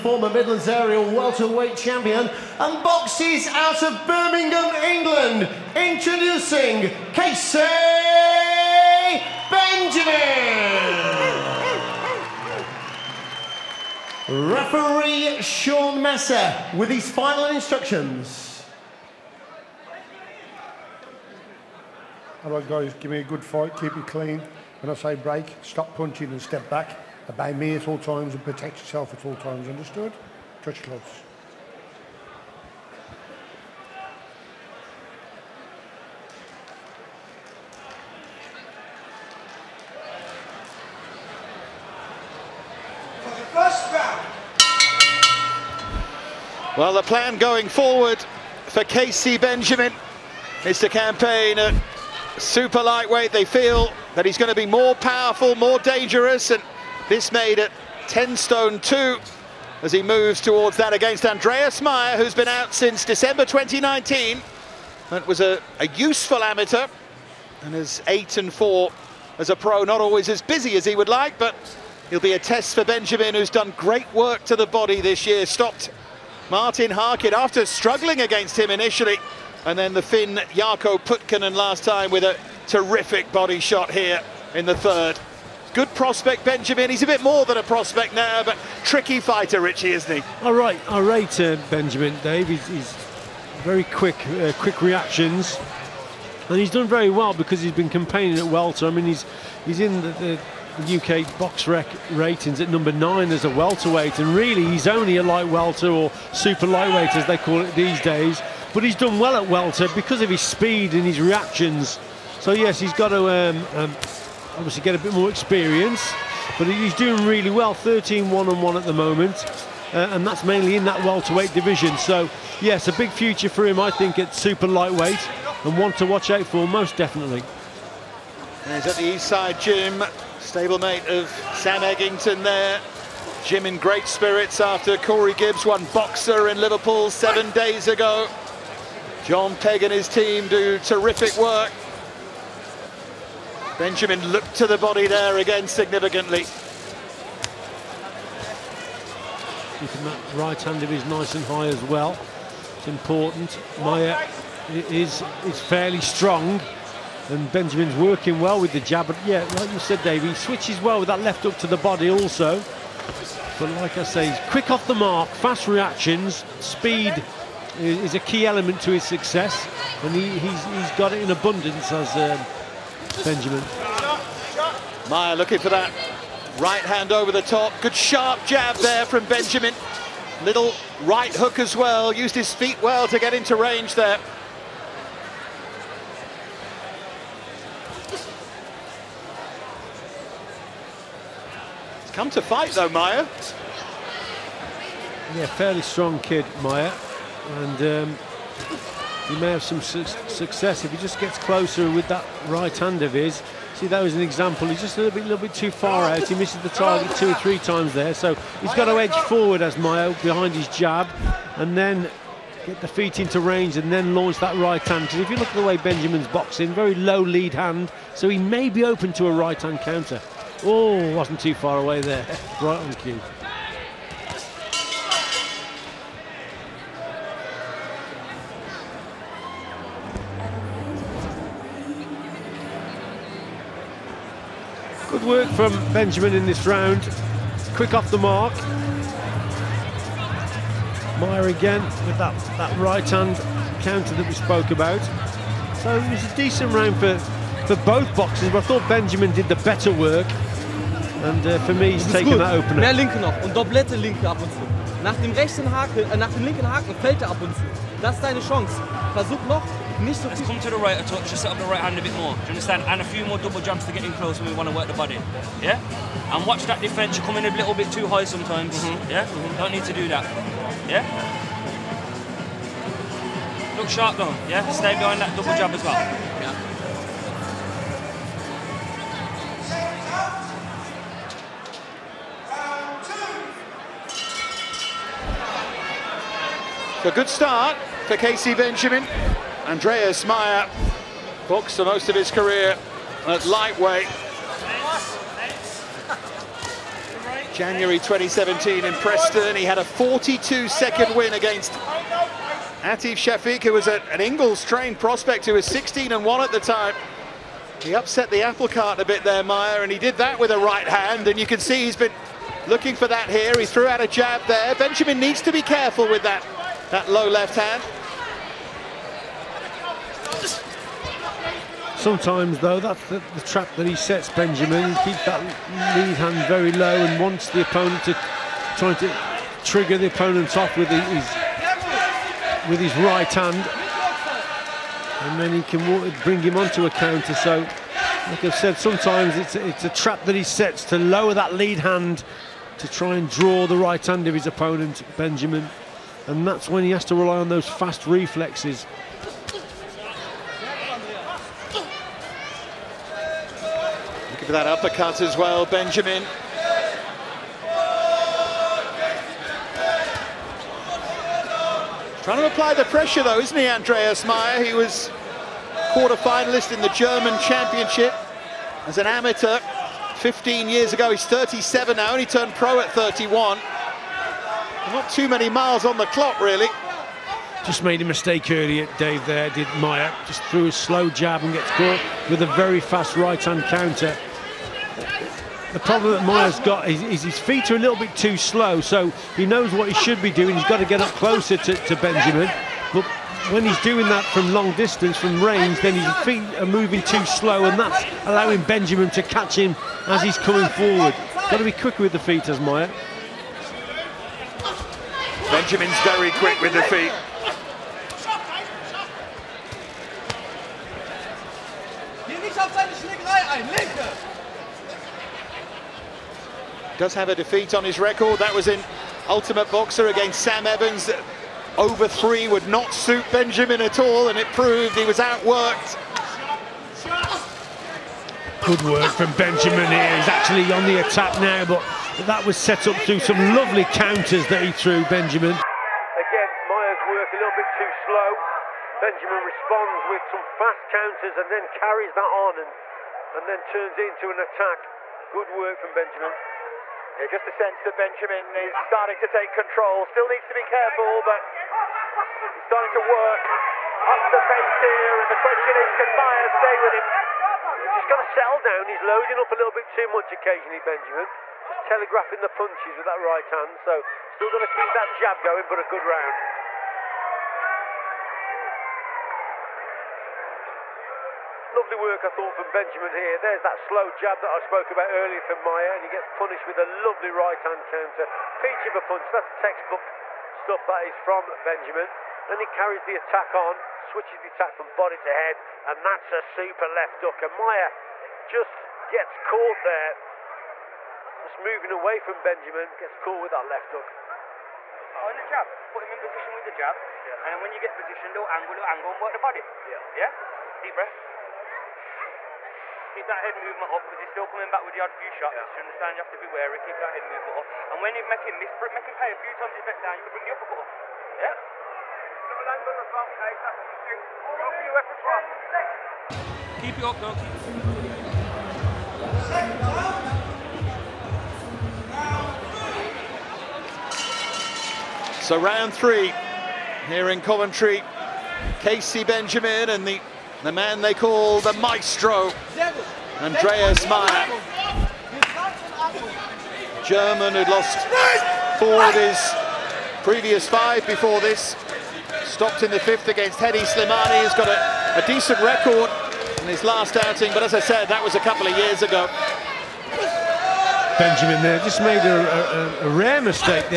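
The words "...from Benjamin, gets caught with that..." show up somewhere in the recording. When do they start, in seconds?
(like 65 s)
492 s.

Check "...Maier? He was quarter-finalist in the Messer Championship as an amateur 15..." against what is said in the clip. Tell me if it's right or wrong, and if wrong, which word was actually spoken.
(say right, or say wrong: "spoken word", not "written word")
wrong: "German", not "Messer".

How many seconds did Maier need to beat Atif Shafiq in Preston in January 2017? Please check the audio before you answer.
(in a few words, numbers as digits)
42.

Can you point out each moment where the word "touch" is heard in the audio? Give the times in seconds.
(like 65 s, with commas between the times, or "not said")
30 s, 261 s.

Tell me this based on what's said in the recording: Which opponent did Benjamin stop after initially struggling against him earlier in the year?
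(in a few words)
Martin Harkin.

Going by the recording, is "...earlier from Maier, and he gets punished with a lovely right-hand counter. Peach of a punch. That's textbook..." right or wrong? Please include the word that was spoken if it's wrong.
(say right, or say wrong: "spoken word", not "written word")
right.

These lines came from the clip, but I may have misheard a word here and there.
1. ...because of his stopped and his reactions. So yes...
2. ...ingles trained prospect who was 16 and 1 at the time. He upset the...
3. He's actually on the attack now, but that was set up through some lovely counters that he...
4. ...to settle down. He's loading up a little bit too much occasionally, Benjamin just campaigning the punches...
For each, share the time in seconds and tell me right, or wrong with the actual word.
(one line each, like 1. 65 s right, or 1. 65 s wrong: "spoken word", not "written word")
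1. 109 s wrong: "speed", not "stopped"
2. 304 s right
3. 430 s right
4. 458 s wrong: "telegraphing", not "campaigning".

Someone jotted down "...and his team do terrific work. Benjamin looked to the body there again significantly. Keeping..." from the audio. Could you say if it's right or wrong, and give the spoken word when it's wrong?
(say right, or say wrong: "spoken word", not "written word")
right.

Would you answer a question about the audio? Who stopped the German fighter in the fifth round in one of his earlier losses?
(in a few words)
Hedi Slimani.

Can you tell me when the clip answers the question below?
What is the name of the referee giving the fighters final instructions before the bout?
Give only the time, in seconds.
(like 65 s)
15 s.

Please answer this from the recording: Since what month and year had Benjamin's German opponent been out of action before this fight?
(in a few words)
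December 2019.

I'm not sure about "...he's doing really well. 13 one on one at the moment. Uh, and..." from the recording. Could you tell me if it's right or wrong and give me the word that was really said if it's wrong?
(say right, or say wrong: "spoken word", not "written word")
right.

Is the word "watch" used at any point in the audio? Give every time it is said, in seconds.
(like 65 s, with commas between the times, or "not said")
126 s, 266 s.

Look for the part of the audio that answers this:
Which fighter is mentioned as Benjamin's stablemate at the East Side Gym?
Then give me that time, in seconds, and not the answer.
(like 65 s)
131 s.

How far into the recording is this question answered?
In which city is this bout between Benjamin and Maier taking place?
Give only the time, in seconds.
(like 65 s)
527 s.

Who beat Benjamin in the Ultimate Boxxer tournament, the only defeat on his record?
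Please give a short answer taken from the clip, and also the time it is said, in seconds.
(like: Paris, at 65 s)
Sam Evans, at 420 s.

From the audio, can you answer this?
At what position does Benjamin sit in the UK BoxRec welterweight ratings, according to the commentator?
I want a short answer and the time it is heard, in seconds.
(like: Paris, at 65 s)
9, at 102 s.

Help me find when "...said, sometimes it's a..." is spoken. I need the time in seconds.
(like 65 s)
338 s.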